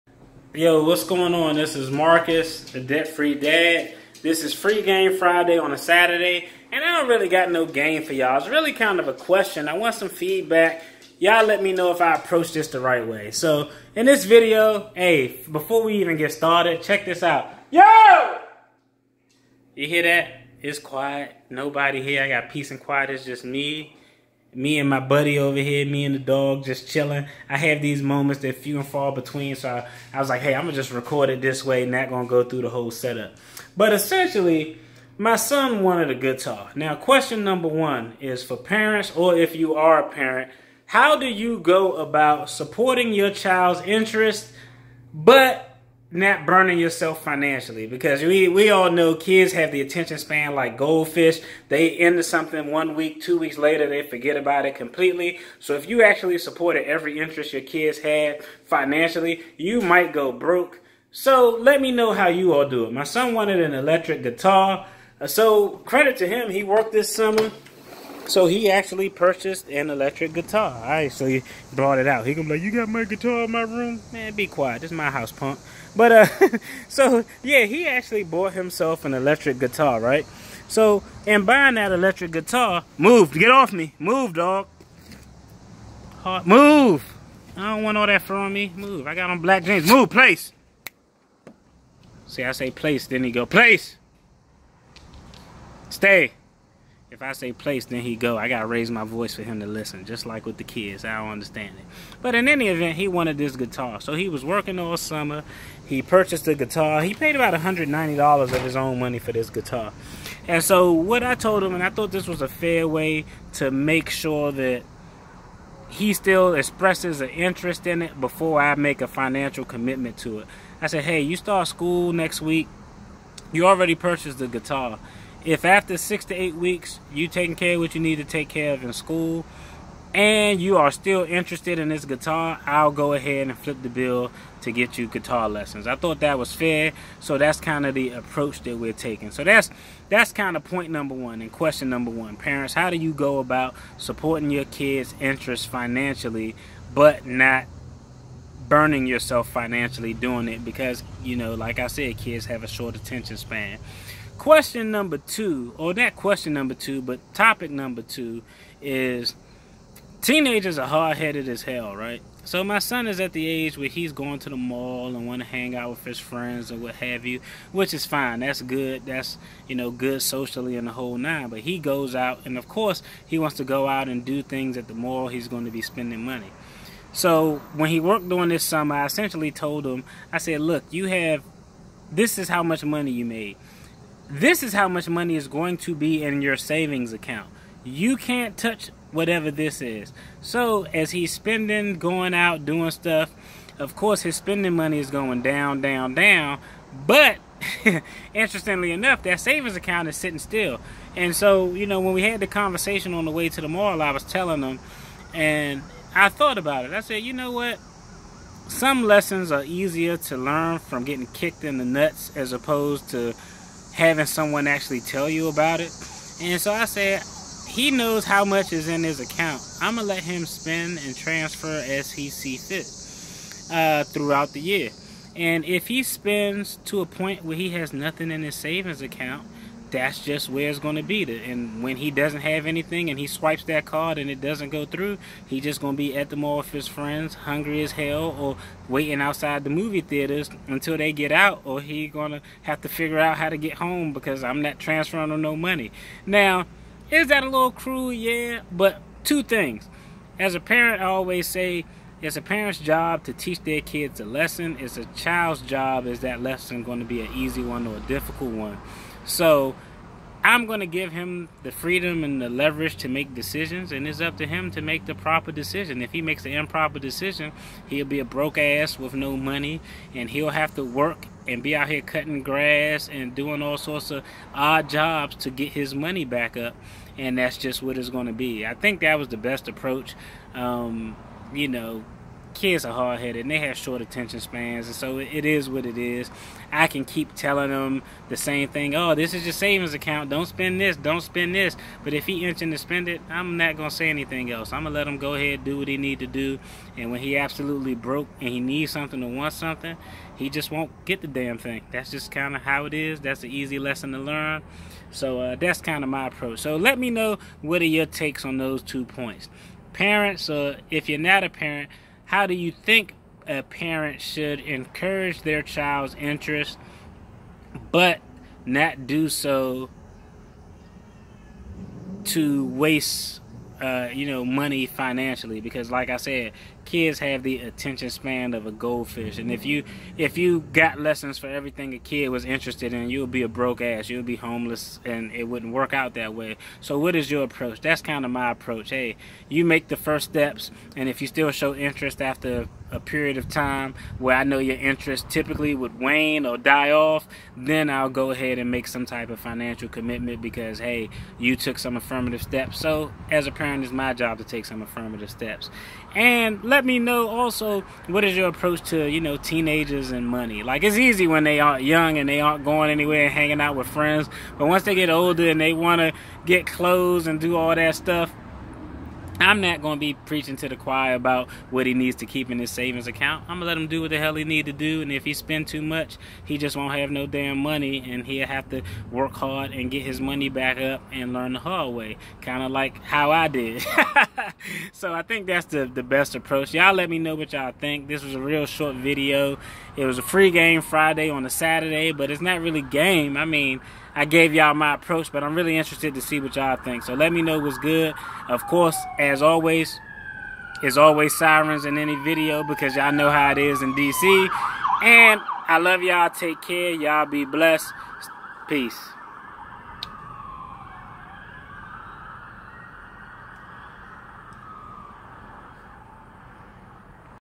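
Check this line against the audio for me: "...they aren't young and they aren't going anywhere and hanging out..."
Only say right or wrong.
right.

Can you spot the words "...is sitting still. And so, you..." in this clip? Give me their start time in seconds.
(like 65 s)
200 s.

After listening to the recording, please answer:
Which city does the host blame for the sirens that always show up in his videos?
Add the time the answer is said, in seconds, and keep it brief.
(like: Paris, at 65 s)
DC, at 403 s.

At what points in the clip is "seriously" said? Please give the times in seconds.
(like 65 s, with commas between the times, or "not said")
not said.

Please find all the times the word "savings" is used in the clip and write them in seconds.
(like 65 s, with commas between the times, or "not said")
186 s, 199 s, 228 s, 289 s, 372 s.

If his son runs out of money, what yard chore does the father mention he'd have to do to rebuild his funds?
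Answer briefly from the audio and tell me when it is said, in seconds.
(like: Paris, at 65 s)
cutting grass, at 272 s.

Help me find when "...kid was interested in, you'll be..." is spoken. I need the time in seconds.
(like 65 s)
331 s.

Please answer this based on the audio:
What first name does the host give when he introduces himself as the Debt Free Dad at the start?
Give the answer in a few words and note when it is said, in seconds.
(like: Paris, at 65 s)
Marcus, at 1 s.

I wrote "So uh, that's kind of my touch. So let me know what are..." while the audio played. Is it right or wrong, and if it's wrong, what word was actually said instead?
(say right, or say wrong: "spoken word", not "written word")
wrong: "approach", not "touch".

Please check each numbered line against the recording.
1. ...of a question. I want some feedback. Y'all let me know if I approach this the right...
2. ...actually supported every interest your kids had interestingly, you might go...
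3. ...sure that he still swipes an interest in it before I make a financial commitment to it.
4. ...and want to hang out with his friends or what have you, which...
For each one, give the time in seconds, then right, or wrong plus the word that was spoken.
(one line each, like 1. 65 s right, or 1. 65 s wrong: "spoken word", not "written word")
1. 8 s right
2. 56 s wrong: "financially", not "interestingly"
3. 114 s wrong: "expresses", not "swipes"
4. 165 s right.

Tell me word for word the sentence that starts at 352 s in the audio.
So, as a parent it's my job to take some affirmative steps.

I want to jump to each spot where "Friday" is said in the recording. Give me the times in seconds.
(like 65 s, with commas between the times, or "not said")
5 s, 390 s.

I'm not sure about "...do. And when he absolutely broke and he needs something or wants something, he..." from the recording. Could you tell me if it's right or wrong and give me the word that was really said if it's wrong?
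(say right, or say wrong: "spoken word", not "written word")
right.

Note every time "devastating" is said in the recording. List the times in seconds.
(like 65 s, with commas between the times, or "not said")
not said.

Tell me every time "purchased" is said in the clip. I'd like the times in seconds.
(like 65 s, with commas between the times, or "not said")
69 s, 106 s, 123 s.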